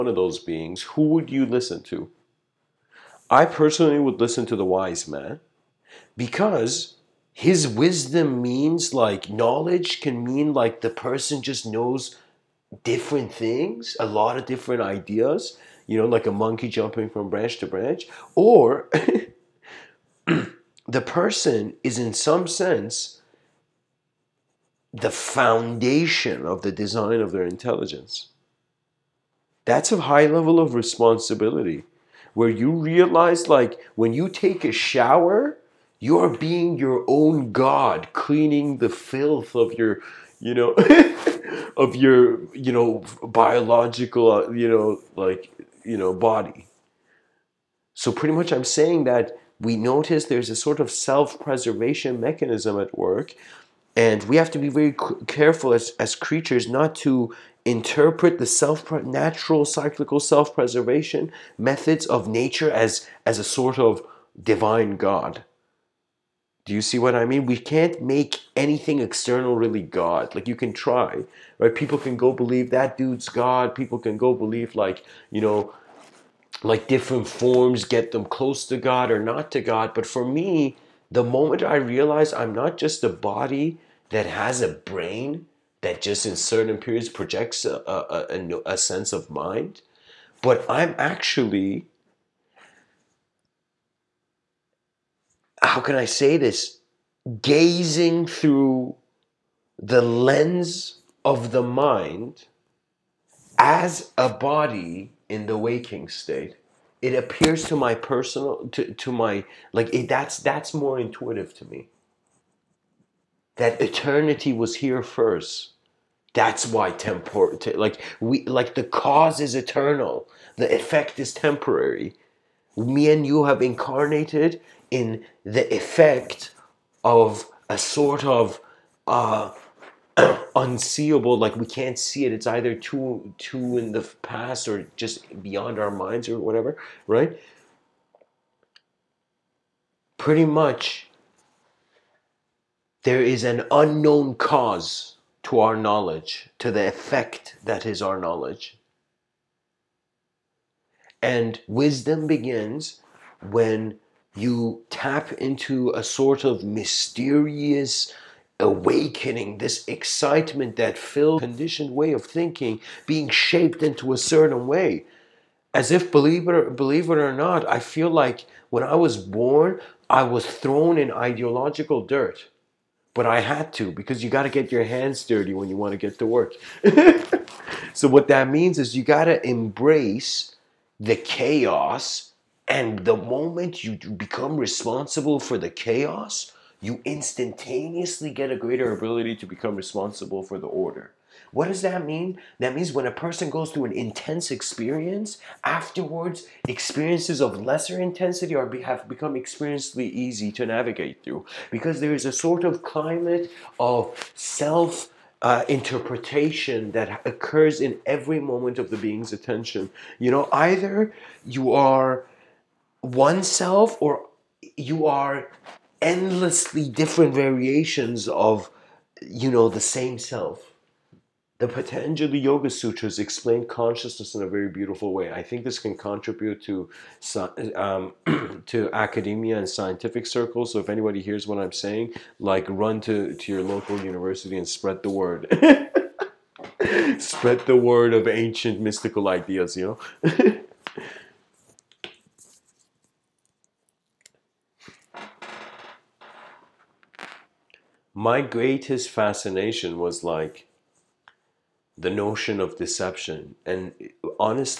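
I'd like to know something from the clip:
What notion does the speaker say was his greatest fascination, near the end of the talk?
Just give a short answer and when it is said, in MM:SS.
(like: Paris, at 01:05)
deception, at 04:12.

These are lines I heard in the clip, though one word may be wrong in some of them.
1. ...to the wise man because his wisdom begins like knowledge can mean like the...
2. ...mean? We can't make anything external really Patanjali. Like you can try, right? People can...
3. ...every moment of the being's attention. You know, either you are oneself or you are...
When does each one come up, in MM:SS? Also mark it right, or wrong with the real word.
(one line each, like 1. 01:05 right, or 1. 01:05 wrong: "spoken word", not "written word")
1. 00:04 wrong: "means", not "begins"
2. 01:07 wrong: "God", not "Patanjali"
3. 03:28 right.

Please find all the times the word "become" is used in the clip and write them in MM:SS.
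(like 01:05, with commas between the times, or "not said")
03:03, 03:09, 03:19.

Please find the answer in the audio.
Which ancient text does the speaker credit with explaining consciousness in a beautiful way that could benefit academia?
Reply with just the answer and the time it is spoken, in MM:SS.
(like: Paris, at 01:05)
Patanjali Yoga Sutras, at 03:41.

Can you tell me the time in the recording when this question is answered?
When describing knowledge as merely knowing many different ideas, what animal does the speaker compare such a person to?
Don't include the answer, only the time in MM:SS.
00:16.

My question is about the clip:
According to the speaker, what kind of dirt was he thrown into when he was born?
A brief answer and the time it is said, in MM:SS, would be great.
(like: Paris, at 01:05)
ideological dirt, at 02:51.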